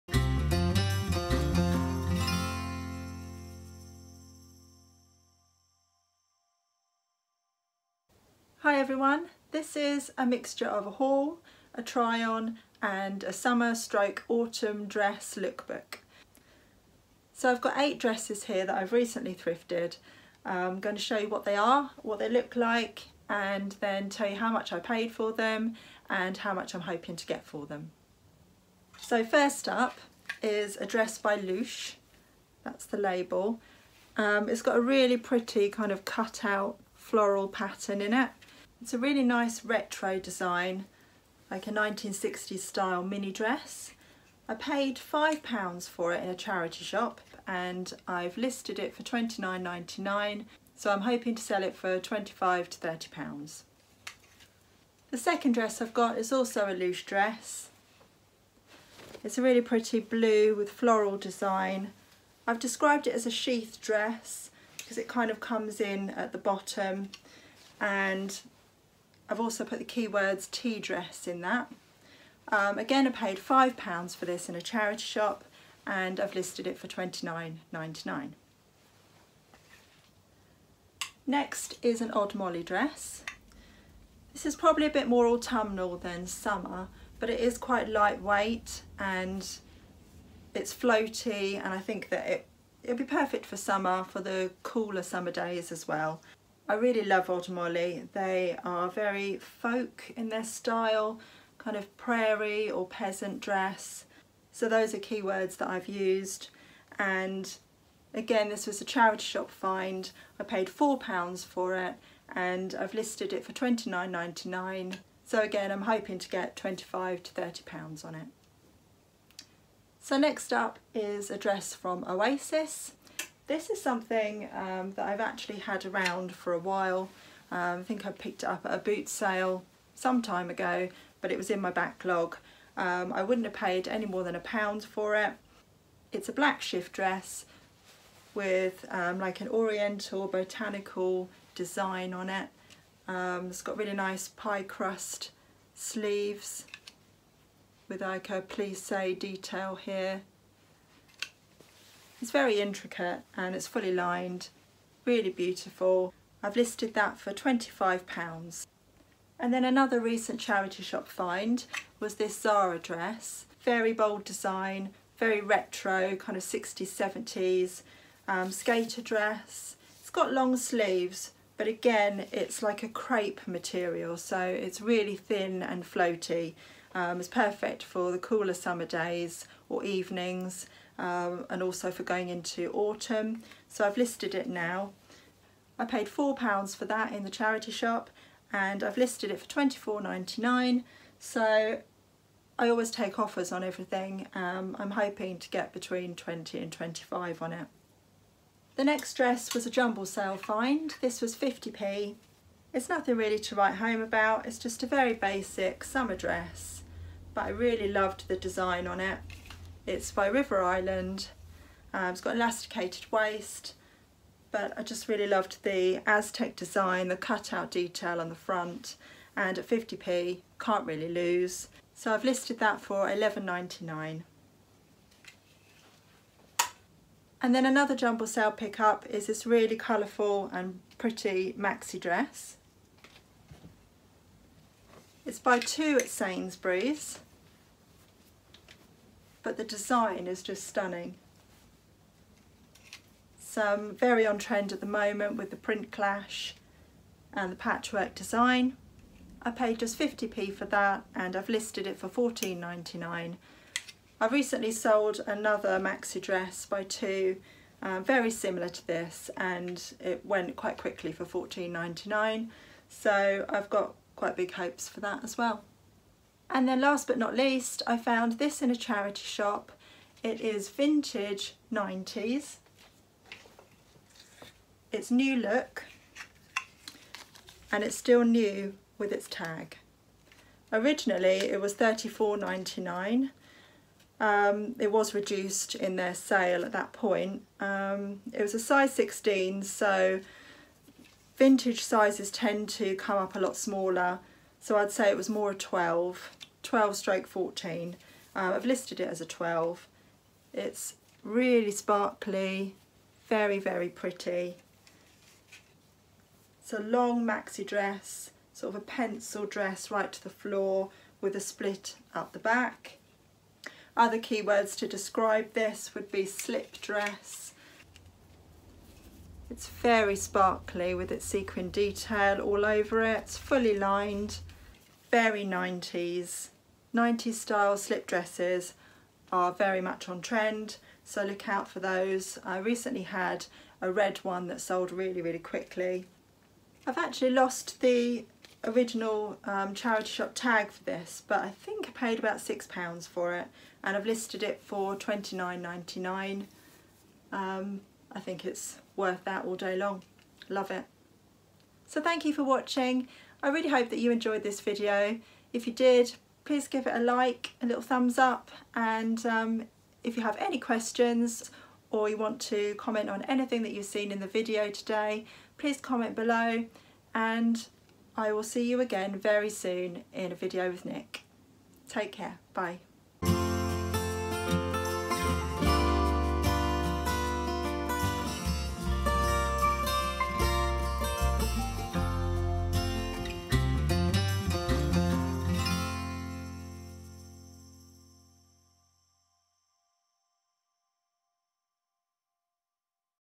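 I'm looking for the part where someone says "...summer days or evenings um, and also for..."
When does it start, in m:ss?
2:58.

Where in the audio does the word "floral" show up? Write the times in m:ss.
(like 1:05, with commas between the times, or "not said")
0:36, 1:00.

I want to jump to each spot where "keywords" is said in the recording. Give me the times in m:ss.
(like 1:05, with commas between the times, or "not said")
1:09, 1:44, 5:14.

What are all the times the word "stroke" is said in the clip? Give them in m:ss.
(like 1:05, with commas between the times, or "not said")
0:13, 4:56.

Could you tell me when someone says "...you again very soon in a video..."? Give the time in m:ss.
6:08.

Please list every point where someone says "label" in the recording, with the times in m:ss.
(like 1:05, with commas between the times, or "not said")
0:32.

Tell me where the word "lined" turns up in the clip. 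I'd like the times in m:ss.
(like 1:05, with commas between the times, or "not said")
2:33, 5:23.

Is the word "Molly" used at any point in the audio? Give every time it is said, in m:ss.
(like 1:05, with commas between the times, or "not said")
1:22, 1:37.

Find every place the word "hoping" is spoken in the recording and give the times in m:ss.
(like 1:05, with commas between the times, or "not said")
0:26, 0:51, 1:55, 3:14.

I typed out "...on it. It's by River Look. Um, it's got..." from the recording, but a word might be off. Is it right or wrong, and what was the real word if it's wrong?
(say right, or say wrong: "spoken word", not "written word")
wrong: "Island", not "Look".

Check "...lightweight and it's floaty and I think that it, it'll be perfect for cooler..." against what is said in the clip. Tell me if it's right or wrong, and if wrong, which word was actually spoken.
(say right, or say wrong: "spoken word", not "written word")
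wrong: "summer", not "cooler".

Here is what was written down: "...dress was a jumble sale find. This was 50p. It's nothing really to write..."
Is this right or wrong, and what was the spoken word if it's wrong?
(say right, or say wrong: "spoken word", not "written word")
right.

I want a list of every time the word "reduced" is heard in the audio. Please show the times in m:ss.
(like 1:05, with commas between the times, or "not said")
4:45.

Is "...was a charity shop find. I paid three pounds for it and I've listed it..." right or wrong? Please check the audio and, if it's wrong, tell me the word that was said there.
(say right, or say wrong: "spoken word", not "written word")
wrong: "four", not "three".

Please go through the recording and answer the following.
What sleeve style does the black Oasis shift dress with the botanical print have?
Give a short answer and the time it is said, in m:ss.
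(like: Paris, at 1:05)
Pie crust sleeves, at 2:24.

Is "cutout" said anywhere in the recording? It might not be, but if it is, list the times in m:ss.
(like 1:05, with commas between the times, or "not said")
3:37.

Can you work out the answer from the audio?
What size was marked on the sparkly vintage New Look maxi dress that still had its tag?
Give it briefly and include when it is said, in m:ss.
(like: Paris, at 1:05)
16, at 4:48.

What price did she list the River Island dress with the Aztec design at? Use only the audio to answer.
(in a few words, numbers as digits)
£11.99.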